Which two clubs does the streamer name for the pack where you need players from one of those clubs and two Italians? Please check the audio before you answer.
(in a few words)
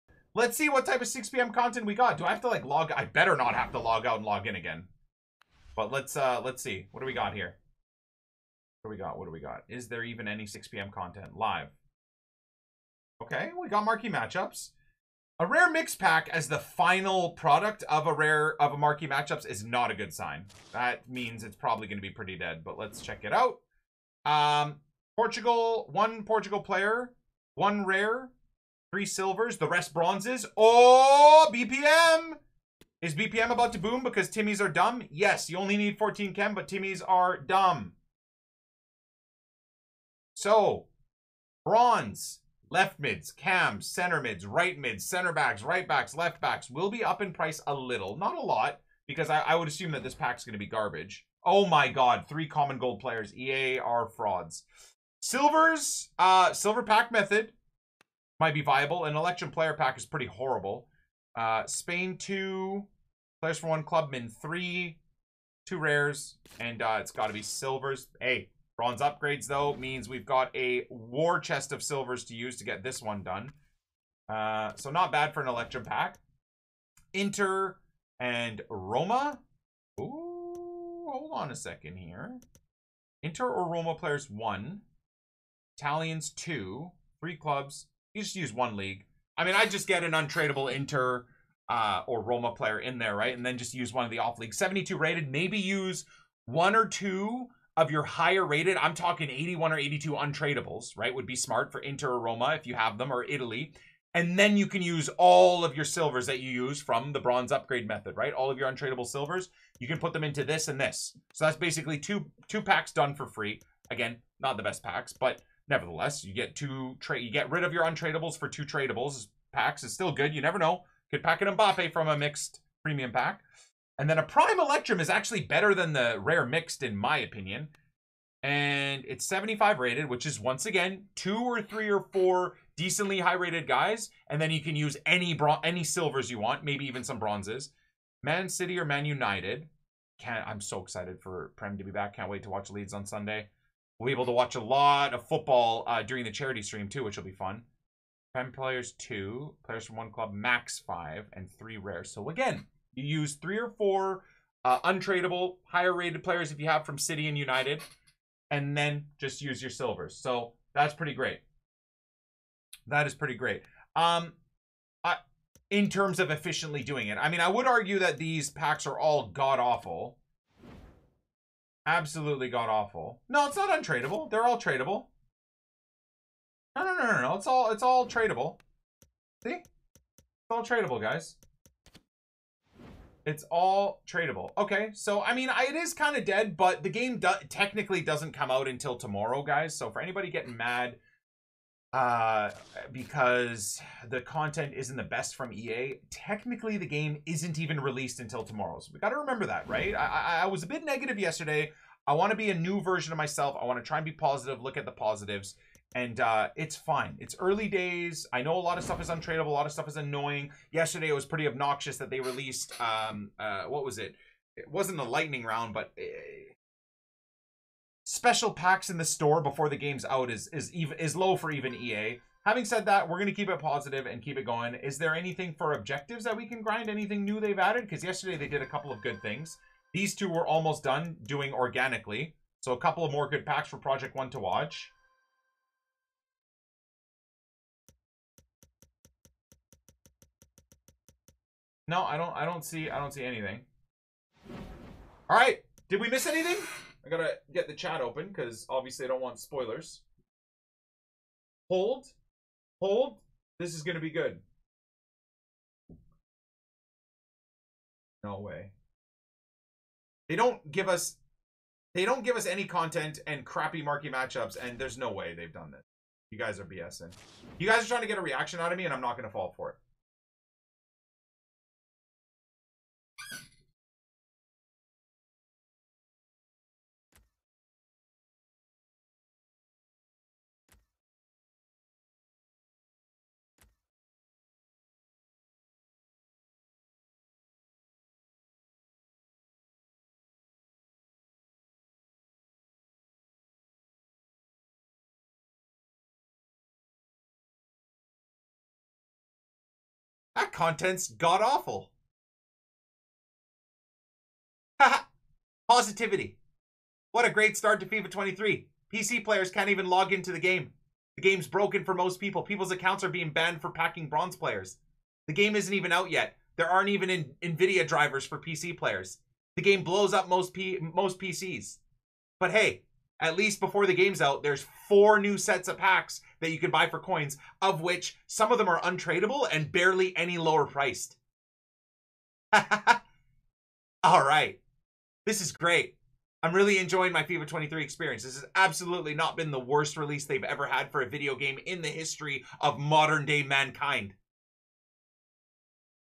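Inter and Roma.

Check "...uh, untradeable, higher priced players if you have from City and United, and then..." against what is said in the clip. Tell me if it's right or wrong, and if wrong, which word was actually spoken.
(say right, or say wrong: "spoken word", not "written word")
wrong: "rated", not "priced".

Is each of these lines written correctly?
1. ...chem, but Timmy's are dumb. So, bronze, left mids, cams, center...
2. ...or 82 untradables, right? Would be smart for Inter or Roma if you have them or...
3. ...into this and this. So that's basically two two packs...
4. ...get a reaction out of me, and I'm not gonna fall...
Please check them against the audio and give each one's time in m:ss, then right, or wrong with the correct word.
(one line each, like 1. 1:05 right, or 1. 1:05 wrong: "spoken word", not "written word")
1. 0:36 right
2. 1:39 right
3. 1:50 right
4. 4:28 right.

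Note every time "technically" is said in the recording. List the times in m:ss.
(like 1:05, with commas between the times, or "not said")
3:07, 3:16.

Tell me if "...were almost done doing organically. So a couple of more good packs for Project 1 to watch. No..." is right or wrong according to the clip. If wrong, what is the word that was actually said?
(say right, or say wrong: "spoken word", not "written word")
right.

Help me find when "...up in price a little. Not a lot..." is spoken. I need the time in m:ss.
0:47.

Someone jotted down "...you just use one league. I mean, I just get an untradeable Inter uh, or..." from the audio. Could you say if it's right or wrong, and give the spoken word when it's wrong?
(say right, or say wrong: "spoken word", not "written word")
right.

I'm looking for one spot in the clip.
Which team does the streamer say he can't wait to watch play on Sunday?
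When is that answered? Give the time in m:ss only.
2:22.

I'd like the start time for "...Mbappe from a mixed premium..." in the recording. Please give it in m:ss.
2:01.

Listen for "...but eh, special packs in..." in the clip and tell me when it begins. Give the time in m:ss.
3:35.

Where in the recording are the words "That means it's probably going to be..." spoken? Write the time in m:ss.
0:20.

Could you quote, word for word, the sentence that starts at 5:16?
There aren't even in NVIDIA drivers for PC players.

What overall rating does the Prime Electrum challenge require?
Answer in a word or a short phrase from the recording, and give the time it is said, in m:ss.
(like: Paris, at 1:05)
75, at 2:09.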